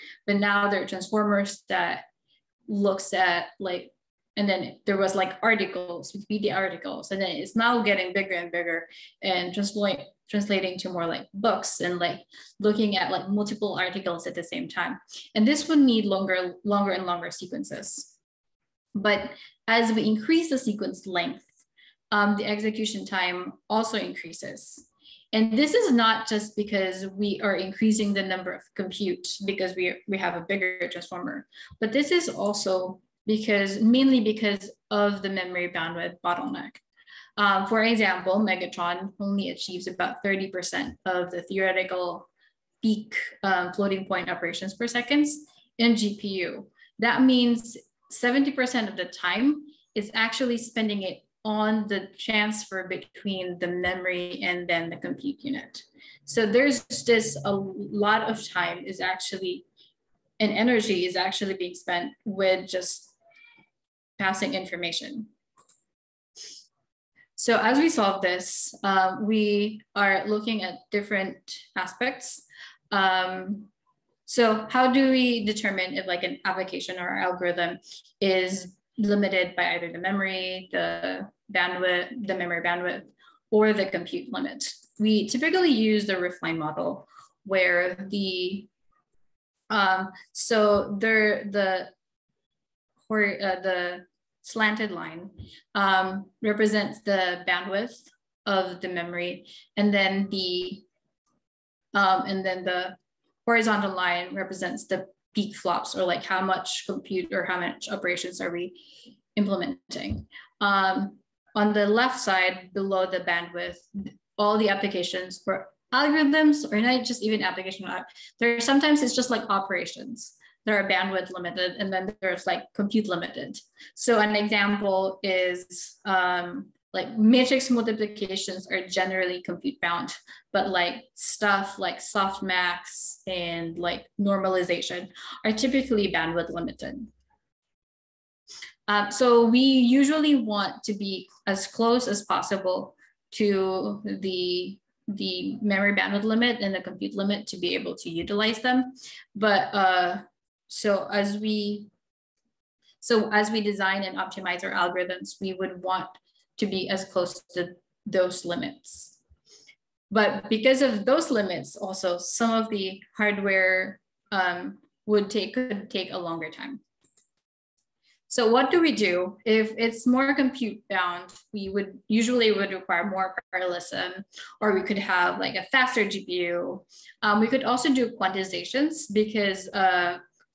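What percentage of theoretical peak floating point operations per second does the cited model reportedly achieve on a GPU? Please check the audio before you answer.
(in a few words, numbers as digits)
30%.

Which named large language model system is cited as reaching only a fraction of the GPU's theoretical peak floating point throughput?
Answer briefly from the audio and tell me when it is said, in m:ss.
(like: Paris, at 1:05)
Megatron, at 0:38.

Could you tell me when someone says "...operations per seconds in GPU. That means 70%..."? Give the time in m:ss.
0:44.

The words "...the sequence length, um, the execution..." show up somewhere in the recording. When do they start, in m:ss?
0:20.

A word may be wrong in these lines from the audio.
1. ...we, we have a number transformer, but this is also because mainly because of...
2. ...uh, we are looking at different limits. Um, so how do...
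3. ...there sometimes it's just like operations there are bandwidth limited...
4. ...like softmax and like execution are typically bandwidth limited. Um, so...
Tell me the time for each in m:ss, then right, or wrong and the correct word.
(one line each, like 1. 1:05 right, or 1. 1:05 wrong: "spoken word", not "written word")
1. 0:29 wrong: "bigger", not "number"
2. 1:08 wrong: "aspects", not "limits"
3. 1:58 right
4. 2:11 wrong: "normalization", not "execution".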